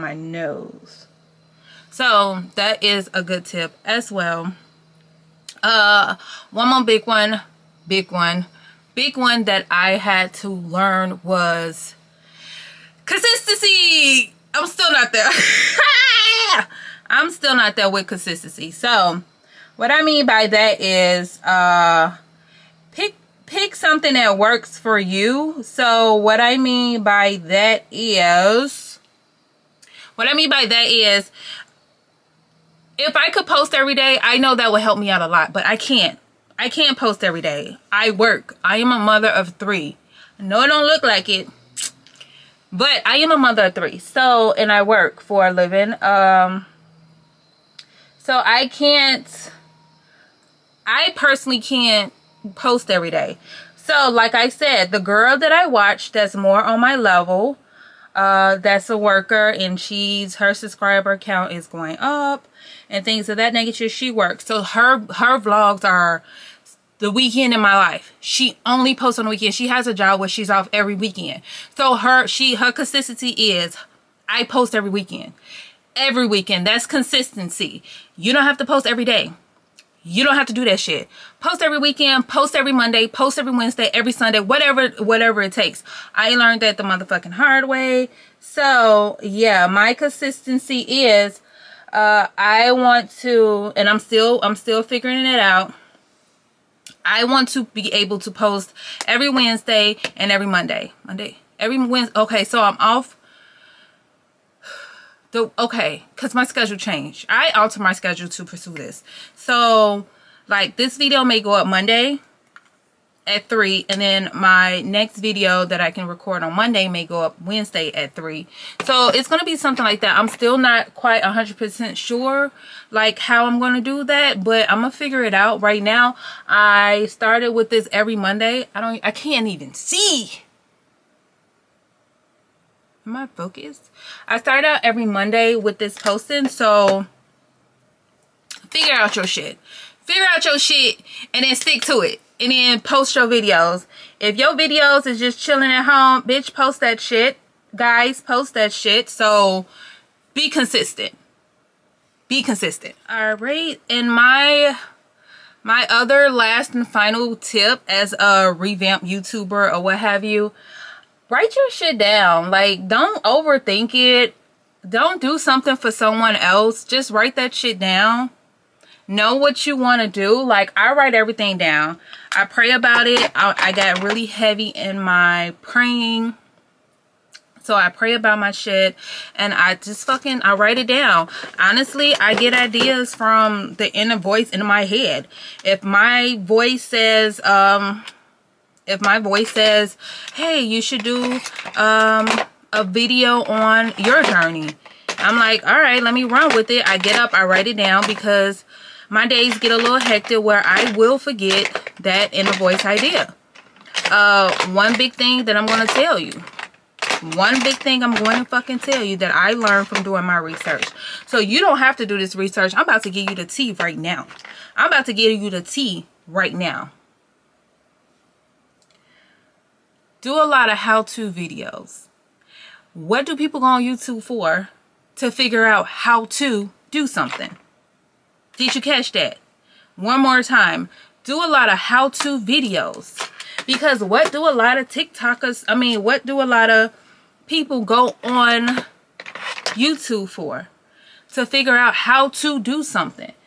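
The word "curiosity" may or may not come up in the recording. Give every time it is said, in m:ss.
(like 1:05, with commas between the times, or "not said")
not said.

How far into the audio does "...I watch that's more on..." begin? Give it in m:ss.
0:55.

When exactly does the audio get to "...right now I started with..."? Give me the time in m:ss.
2:05.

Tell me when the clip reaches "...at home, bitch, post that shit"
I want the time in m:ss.
2:25.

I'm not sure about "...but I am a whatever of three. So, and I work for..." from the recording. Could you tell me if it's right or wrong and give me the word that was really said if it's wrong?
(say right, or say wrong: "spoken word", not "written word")
wrong: "mother", not "whatever".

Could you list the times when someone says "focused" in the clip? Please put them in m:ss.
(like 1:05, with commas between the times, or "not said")
2:13.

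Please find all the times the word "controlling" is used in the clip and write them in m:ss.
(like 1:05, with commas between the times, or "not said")
not said.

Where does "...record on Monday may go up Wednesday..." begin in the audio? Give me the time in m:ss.
1:56.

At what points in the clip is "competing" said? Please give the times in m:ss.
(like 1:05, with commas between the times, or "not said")
not said.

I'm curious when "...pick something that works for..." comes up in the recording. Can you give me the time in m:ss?
0:23.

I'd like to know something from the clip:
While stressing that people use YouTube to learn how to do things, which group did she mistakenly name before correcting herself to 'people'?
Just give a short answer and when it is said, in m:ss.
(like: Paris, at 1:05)
TikTokers, at 3:54.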